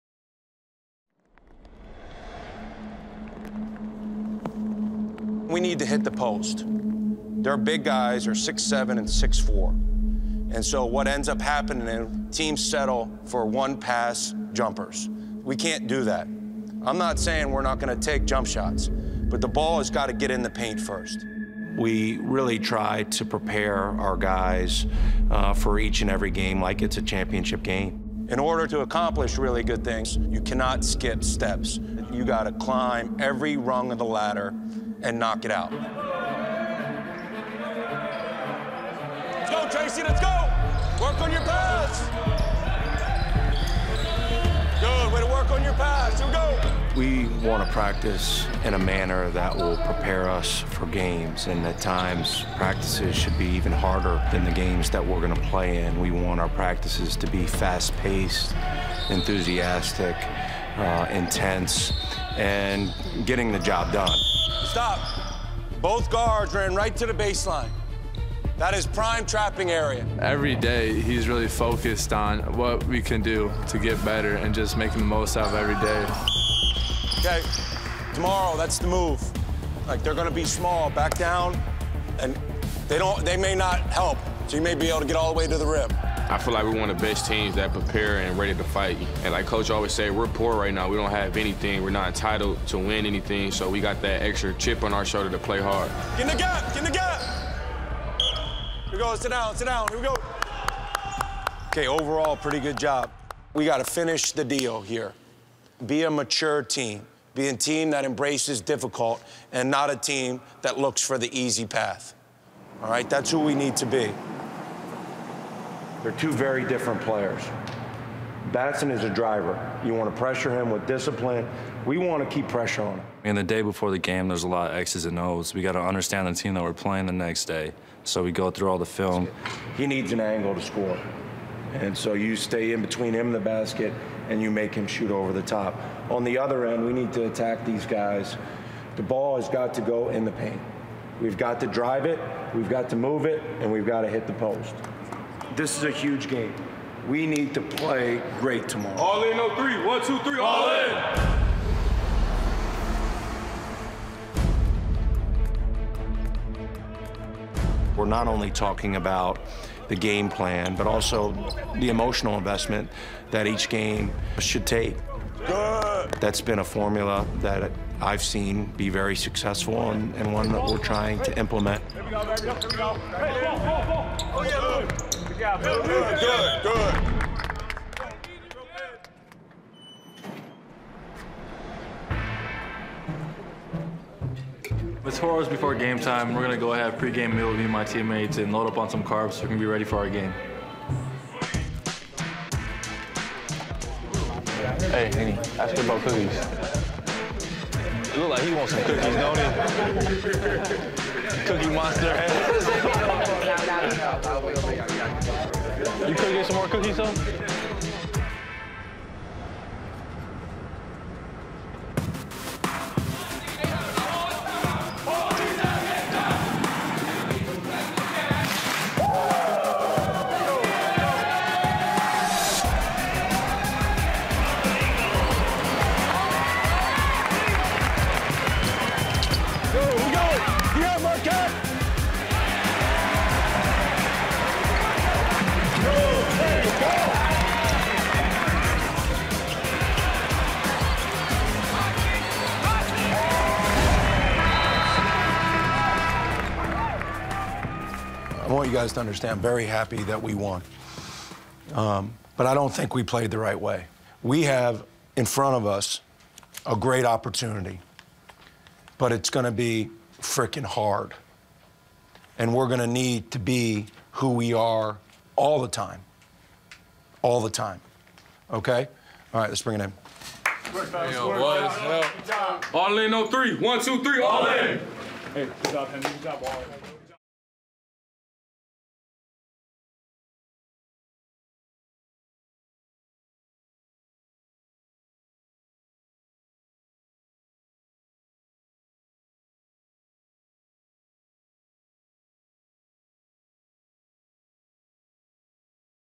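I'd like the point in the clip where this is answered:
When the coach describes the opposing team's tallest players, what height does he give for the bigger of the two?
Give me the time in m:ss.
0:08.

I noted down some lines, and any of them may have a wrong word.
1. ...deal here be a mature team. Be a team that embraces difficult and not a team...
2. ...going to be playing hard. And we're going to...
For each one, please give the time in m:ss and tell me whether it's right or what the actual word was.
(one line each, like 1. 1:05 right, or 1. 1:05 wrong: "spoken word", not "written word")
1. 1:44 right
2. 4:19 wrong: "freaking", not "playing".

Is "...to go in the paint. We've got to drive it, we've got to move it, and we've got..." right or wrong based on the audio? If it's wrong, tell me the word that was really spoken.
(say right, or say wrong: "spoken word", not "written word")
right.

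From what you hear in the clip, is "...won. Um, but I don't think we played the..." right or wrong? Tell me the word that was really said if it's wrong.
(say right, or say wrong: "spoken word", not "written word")
right.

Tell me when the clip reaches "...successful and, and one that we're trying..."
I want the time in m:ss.
2:49.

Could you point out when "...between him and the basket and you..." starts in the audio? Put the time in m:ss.
2:12.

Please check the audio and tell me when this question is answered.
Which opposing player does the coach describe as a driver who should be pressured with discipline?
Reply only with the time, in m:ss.
1:58.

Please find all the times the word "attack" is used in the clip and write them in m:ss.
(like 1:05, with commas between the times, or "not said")
2:17.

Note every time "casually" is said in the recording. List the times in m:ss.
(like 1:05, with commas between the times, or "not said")
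not said.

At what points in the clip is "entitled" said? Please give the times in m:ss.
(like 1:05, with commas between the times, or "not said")
1:32.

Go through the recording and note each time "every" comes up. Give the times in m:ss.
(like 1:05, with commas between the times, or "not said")
0:26, 0:33, 1:10, 1:15.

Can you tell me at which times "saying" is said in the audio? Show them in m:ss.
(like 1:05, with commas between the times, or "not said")
0:17.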